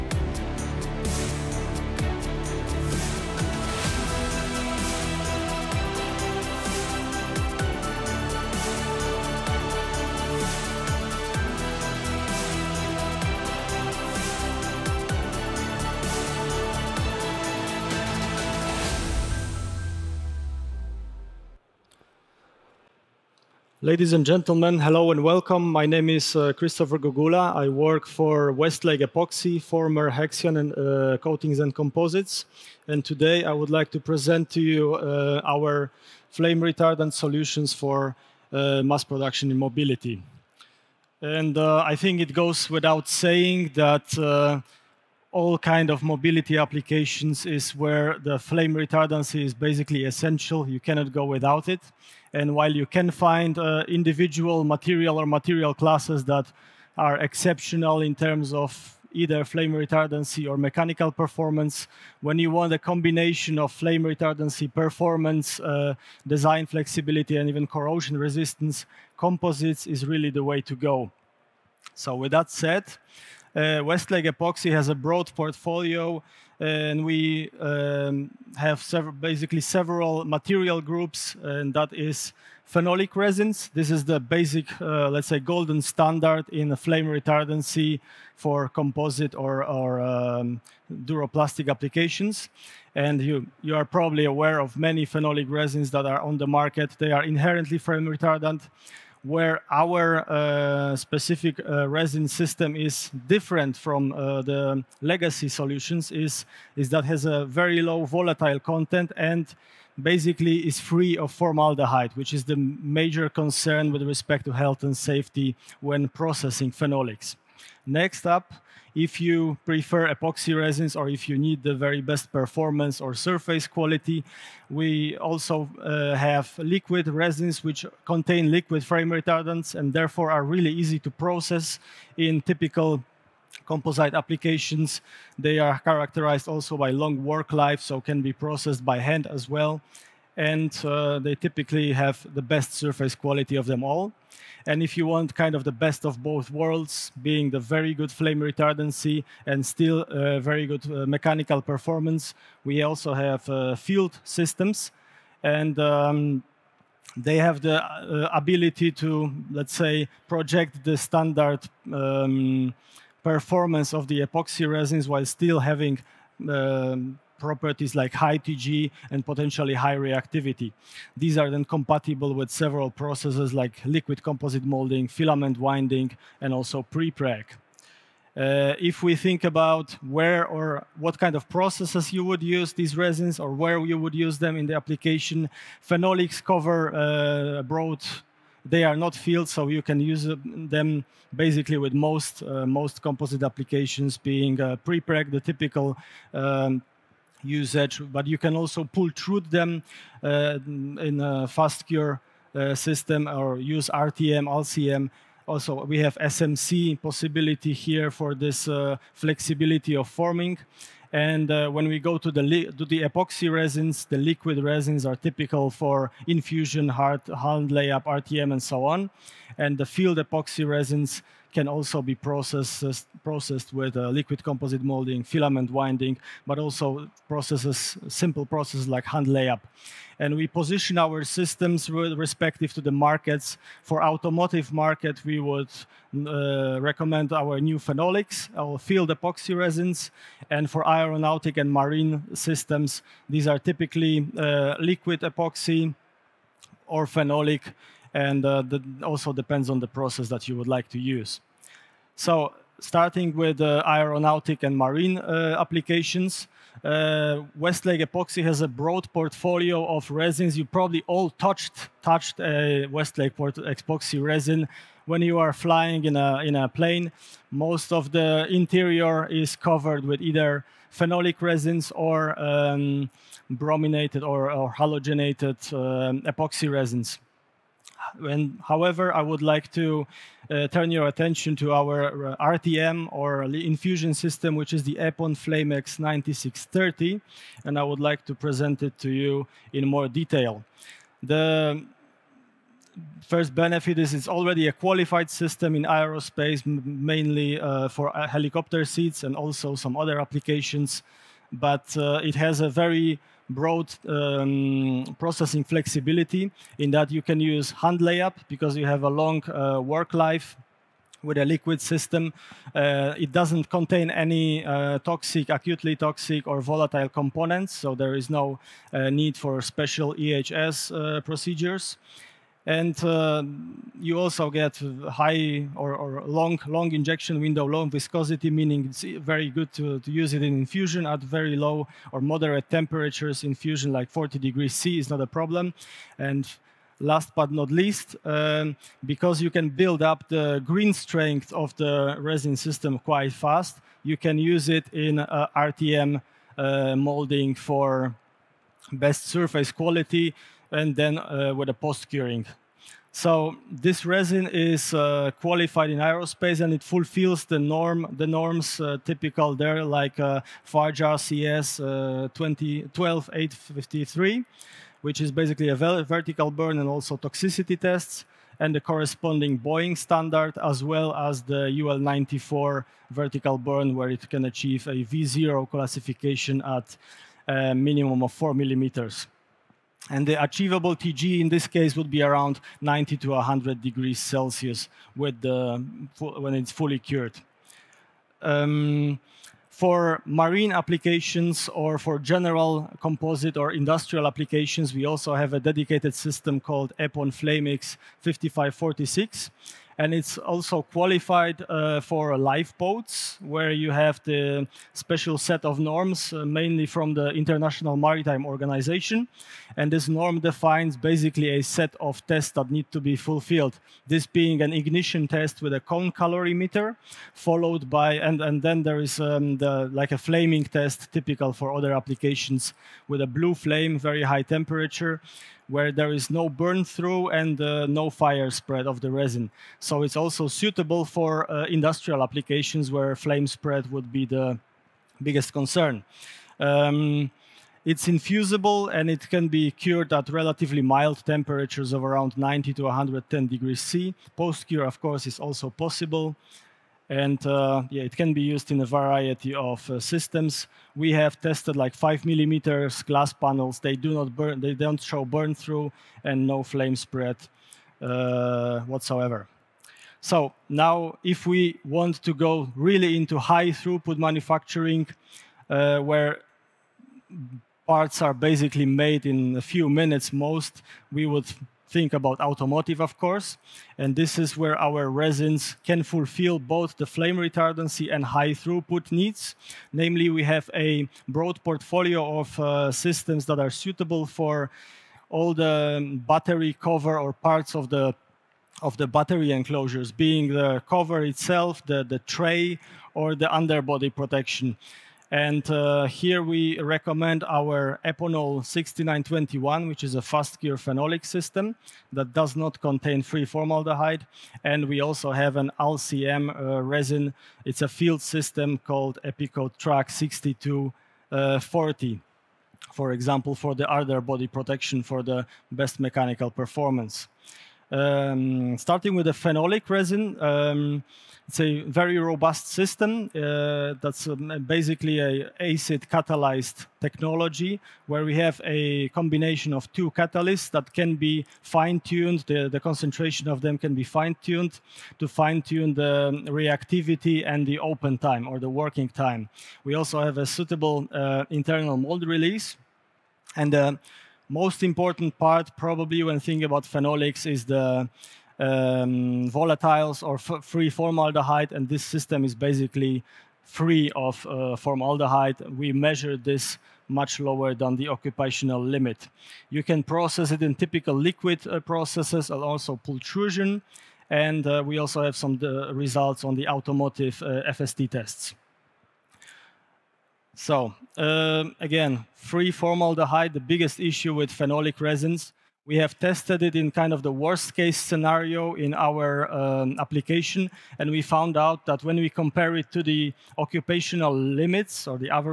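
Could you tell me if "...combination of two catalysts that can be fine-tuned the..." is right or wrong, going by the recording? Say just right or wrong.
right.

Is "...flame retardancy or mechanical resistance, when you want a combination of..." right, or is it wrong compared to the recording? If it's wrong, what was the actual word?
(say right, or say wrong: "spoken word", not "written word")
wrong: "performance", not "resistance".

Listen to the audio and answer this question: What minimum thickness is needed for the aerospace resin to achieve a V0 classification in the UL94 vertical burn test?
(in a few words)
4 millimeters.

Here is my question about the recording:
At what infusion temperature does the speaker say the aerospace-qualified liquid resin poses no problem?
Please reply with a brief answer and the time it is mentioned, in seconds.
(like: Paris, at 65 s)
40 degrees C, at 334 s.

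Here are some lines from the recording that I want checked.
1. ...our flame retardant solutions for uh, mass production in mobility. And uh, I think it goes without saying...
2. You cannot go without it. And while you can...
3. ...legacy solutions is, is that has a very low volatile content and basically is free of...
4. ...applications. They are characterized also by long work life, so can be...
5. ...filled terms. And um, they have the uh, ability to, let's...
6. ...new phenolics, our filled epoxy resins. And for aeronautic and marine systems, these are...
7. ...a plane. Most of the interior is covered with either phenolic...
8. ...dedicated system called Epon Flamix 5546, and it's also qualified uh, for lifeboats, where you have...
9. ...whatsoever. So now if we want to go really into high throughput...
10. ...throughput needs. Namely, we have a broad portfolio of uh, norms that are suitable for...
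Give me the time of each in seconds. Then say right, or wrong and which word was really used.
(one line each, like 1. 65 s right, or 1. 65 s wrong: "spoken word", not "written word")
1. 35 s right
2. 50 s right
3. 105 s right
4. 134 s right
5. 153 s wrong: "systems", not "terms"
6. 237 s right
7. 266 s right
8. 395 s right
9. 458 s right
10. 478 s wrong: "systems", not "norms".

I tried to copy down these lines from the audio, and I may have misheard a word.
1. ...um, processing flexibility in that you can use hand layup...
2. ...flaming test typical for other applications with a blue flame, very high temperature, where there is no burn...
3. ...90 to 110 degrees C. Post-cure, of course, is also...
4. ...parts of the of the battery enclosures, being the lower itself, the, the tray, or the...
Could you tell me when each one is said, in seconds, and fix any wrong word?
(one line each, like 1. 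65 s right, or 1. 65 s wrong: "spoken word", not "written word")
1. 304 s right
2. 420 s right
3. 442 s right
4. 487 s wrong: "cover", not "lower".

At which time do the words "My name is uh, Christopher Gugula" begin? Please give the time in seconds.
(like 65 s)
25 s.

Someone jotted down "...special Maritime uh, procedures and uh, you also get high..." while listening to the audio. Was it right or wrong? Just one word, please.
wrong.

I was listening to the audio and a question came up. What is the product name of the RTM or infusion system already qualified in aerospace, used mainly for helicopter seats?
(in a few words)
Epon Flamex 9630.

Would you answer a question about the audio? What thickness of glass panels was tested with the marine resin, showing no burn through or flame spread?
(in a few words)
5 millimeters.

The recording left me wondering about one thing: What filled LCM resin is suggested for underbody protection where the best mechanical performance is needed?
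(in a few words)
Epikote TRAC 6240.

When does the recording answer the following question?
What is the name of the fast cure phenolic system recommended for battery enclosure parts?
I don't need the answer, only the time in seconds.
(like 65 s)
498 s.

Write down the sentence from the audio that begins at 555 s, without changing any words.
We measure this much lower than the occupational limit.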